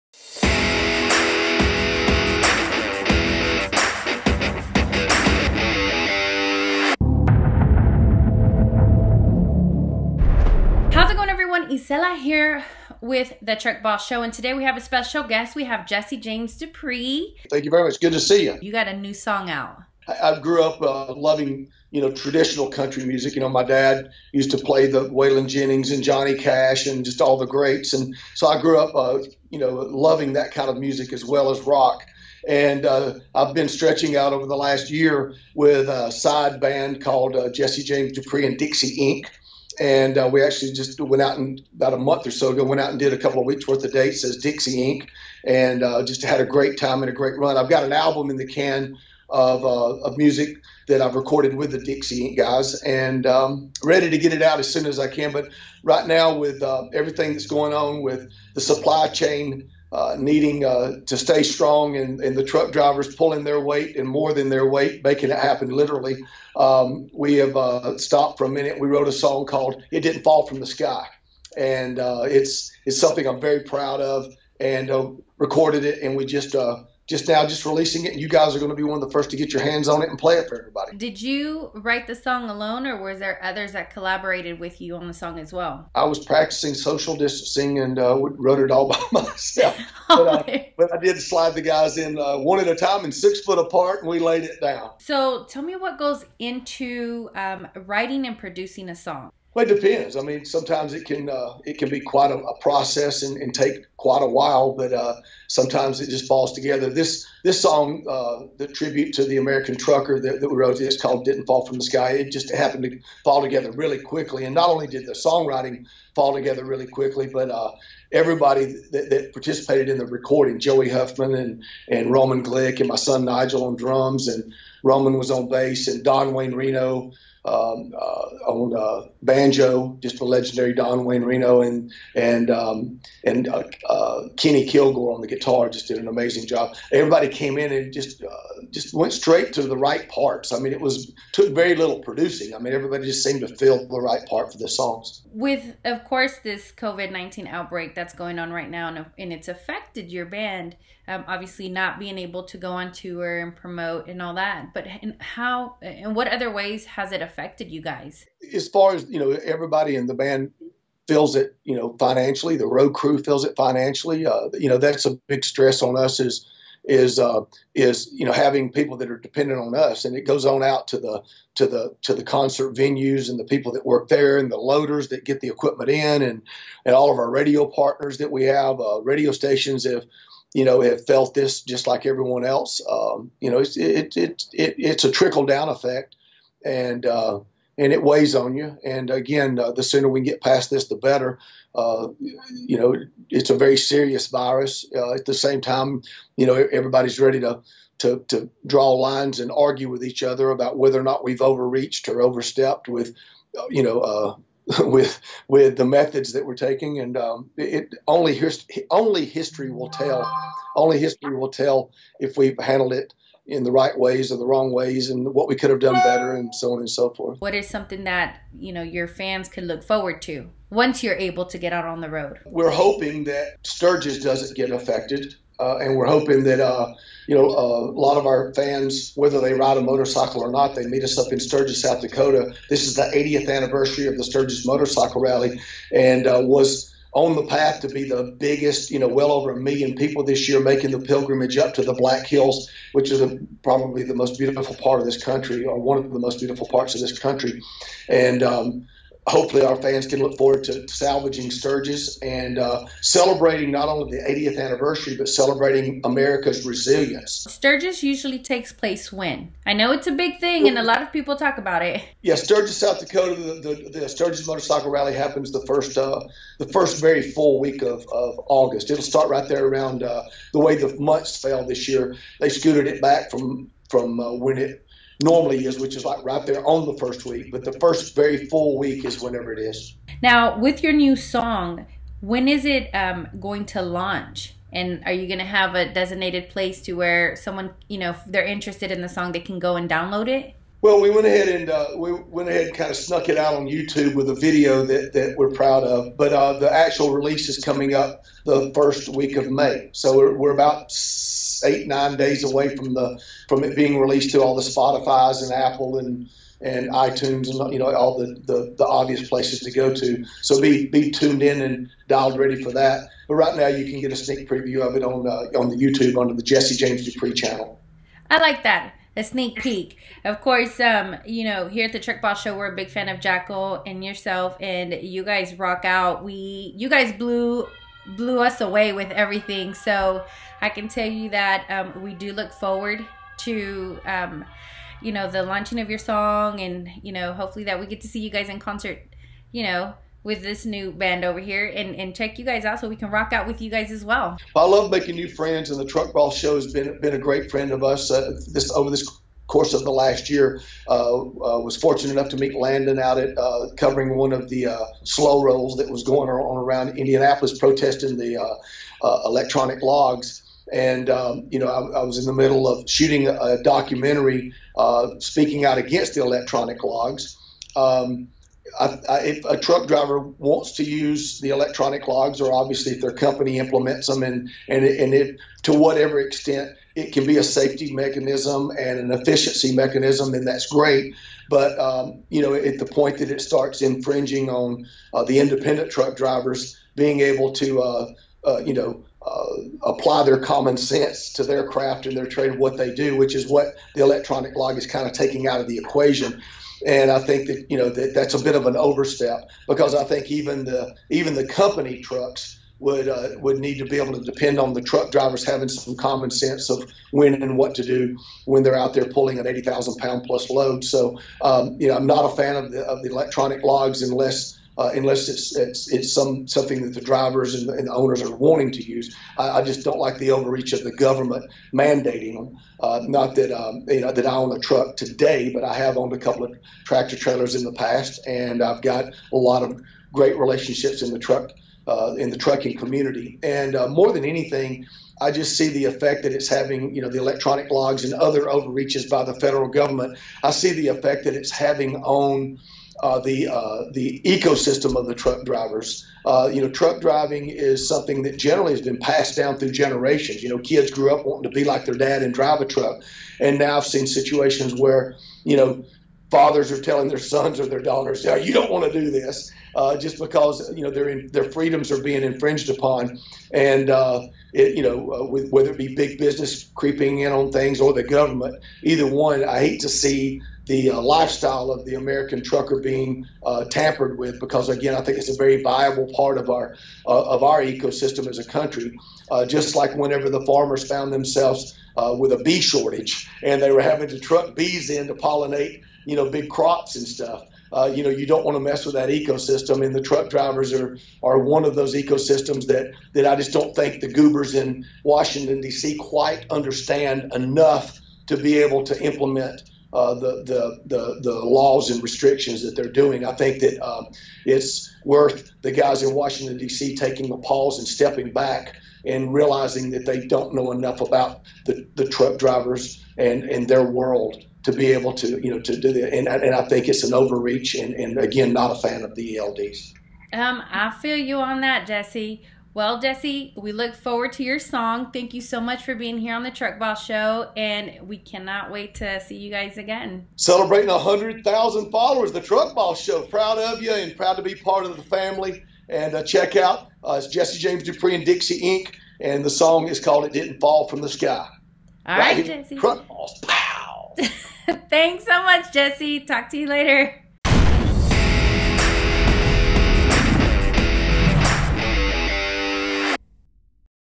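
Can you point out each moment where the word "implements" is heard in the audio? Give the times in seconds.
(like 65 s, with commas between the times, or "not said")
373 s, 499 s.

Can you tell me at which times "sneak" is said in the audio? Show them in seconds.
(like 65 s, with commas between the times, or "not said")
314 s, 319 s.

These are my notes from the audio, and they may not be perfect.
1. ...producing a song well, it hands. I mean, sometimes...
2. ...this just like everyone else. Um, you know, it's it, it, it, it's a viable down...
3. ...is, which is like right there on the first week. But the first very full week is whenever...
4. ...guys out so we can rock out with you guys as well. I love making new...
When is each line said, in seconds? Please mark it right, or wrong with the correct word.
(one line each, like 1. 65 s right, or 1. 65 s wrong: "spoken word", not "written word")
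1. 98 s wrong: "depends", not "hands"
2. 181 s wrong: "trickle", not "viable"
3. 275 s right
4. 342 s right.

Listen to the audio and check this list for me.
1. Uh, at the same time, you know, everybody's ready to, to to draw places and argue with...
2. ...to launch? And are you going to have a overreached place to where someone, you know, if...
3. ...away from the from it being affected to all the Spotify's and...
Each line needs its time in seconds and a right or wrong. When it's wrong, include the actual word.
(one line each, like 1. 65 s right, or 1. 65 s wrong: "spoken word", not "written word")
1. 194 s wrong: "lines", not "places"
2. 283 s wrong: "designated", not "overreached"
3. 302 s wrong: "released", not "affected".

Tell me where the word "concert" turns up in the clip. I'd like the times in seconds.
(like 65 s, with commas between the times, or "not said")
172 s, 338 s.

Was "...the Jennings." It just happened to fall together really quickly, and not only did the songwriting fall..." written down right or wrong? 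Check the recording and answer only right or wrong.
wrong.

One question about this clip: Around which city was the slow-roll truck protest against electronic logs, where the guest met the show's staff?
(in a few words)
Indianapolis.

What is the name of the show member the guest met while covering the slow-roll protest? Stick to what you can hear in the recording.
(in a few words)
Landon.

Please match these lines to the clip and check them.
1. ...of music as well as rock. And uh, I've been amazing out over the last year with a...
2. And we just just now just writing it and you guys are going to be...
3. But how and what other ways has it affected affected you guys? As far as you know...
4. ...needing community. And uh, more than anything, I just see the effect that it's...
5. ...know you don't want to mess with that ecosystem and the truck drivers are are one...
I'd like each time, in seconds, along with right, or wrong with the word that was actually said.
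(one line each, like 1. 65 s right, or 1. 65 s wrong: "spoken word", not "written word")
1. 30 s wrong: "stretching", not "amazing"
2. 76 s wrong: "releasing", not "writing"
3. 154 s right
4. 432 s wrong: "trucking", not "needing"
5. 488 s right.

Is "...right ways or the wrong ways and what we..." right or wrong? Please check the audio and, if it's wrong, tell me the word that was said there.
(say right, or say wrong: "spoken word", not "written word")
right.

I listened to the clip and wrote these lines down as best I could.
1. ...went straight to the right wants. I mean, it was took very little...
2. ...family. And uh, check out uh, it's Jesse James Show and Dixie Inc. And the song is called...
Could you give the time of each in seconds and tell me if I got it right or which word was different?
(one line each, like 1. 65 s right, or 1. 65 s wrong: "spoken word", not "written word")
1. 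138 s wrong: "parts", not "wants"
2. 535 s wrong: "Dupree", not "Show".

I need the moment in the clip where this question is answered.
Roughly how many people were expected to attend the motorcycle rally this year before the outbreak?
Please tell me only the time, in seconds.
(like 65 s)
239 s.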